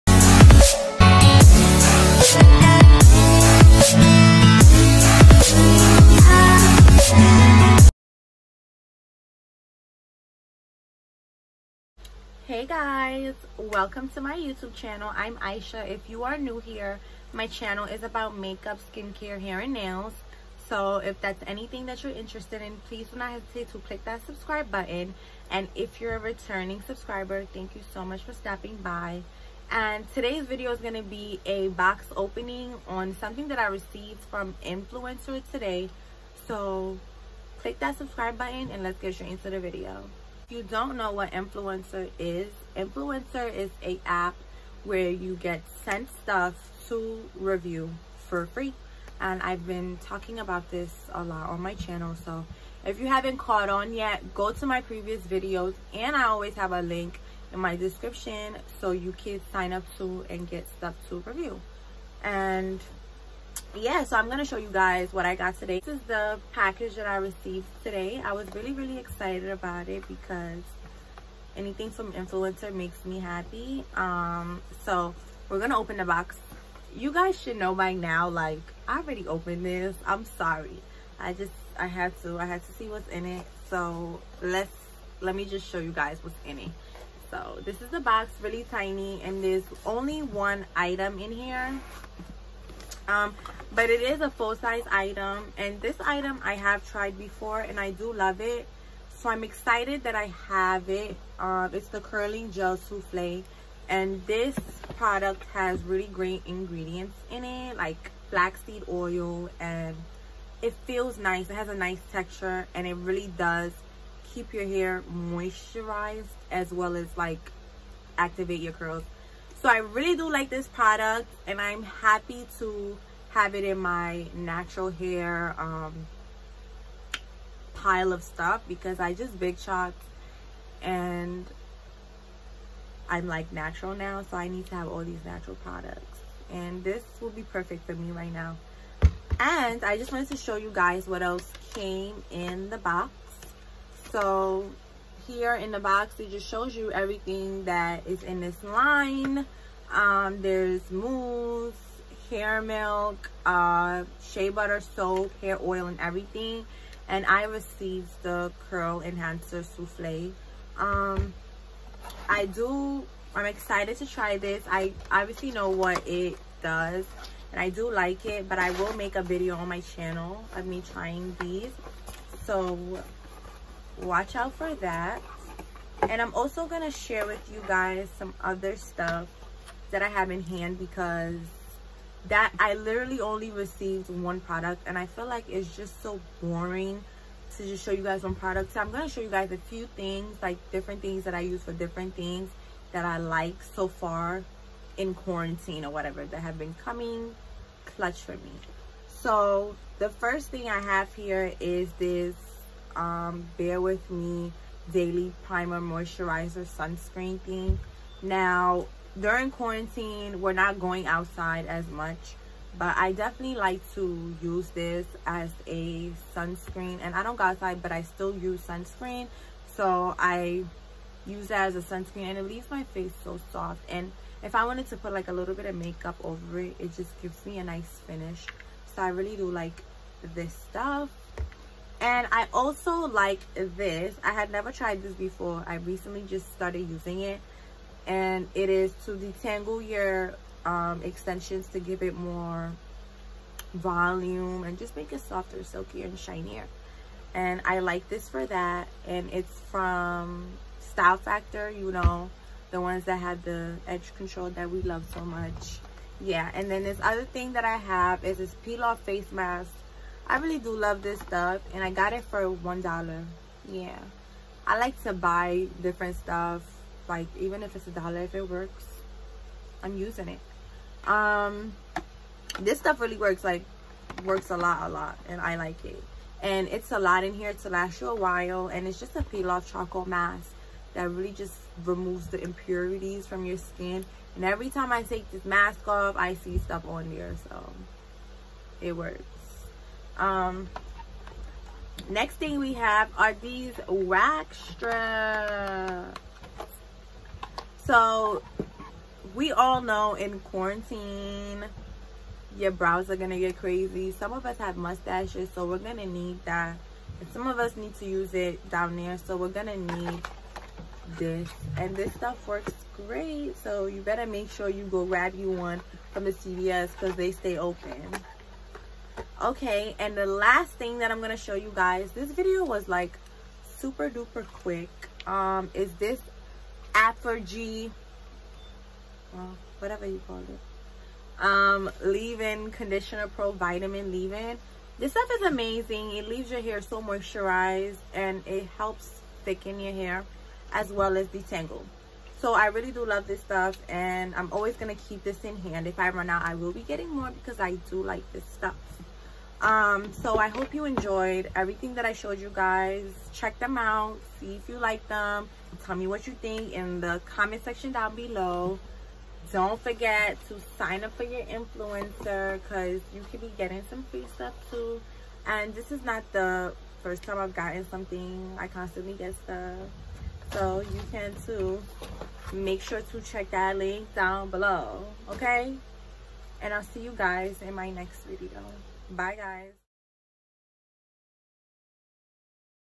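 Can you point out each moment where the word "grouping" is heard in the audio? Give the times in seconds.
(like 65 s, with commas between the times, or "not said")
not said.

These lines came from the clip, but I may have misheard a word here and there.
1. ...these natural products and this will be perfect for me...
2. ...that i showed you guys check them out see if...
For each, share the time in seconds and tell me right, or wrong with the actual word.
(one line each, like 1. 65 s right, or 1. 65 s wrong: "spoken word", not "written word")
1. 135 s right
2. 351 s right.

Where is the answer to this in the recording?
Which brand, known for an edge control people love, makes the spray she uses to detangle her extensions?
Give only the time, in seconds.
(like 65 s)
250 s.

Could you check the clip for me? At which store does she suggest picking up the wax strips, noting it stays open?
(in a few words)
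CVS.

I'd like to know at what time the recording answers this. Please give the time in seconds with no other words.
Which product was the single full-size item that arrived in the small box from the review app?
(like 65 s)
102 s.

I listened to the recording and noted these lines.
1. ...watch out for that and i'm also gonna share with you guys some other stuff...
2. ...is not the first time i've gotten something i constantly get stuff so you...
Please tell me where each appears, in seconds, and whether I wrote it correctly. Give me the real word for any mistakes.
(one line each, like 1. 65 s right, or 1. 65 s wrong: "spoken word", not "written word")
1. 174 s right
2. 365 s right.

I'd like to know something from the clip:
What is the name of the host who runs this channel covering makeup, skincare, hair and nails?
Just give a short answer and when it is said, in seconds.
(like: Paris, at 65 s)
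Aisha, at 15 s.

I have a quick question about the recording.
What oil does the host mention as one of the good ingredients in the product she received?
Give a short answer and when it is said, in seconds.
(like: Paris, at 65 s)
Flaxseed oil, at 108 s.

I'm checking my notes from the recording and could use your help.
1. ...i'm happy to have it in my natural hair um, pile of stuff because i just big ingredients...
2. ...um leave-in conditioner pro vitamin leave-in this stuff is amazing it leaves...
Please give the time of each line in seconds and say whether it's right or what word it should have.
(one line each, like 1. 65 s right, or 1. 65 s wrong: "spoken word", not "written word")
1. 121 s wrong: "shots", not "ingredients"
2. 331 s right.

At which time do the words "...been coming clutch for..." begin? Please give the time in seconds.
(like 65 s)
196 s.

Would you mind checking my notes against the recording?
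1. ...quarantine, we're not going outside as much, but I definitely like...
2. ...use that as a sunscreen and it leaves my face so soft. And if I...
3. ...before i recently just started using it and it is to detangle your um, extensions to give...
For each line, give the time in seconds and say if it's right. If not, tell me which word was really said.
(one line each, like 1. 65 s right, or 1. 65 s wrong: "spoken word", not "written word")
1. 209 s right
2. 221 s right
3. 235 s right.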